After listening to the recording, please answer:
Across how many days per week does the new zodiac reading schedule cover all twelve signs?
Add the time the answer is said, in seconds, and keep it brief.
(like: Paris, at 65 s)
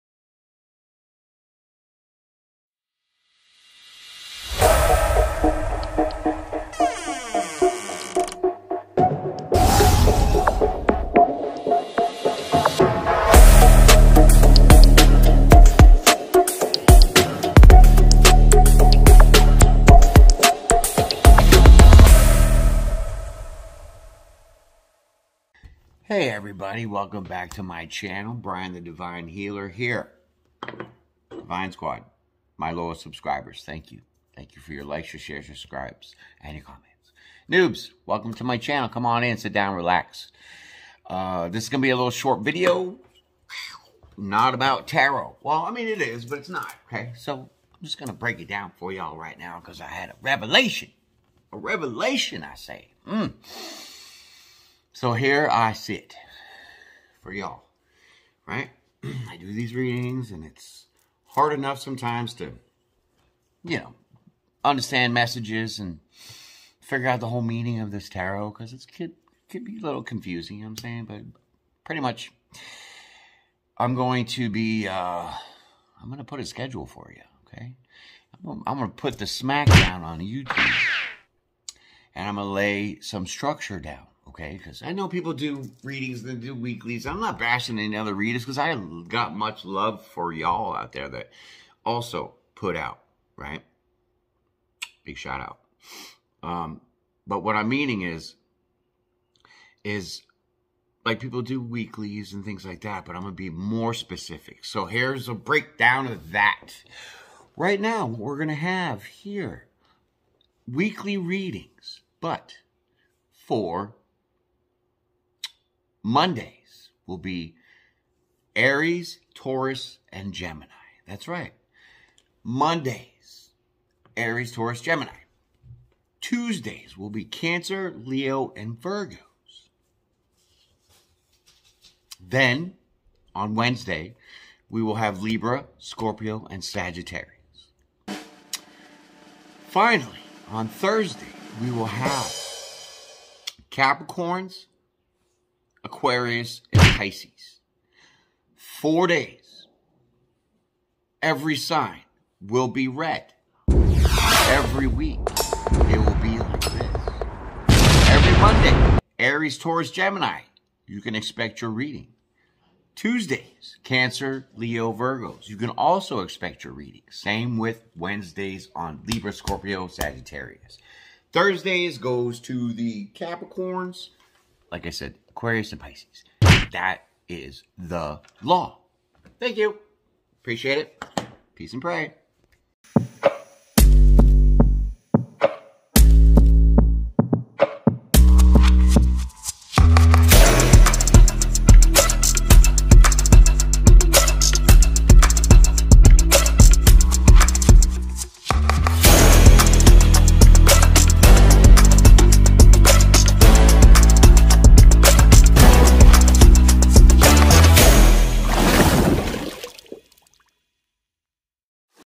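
4, at 148 s.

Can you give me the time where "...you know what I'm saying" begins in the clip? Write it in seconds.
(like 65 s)
70 s.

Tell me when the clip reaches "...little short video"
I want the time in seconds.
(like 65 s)
41 s.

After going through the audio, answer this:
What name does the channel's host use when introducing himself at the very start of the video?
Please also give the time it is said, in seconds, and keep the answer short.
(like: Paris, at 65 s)
Brian the Divine Healer, at 28 s.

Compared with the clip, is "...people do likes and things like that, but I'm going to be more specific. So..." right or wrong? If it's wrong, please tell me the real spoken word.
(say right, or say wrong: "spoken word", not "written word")
wrong: "weeklies", not "likes".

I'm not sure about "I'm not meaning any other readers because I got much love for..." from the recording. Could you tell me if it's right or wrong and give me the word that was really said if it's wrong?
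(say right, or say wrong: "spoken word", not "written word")
wrong: "bashing", not "meaning".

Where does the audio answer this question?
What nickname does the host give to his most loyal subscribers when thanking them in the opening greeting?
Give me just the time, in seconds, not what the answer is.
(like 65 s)
31 s.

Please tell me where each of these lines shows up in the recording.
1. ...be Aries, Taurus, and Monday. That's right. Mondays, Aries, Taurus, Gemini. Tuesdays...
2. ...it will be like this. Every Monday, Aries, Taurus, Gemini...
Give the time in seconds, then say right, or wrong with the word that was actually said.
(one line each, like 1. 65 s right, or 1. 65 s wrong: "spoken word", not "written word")
1. 117 s wrong: "Gemini", not "Monday"
2. 155 s right.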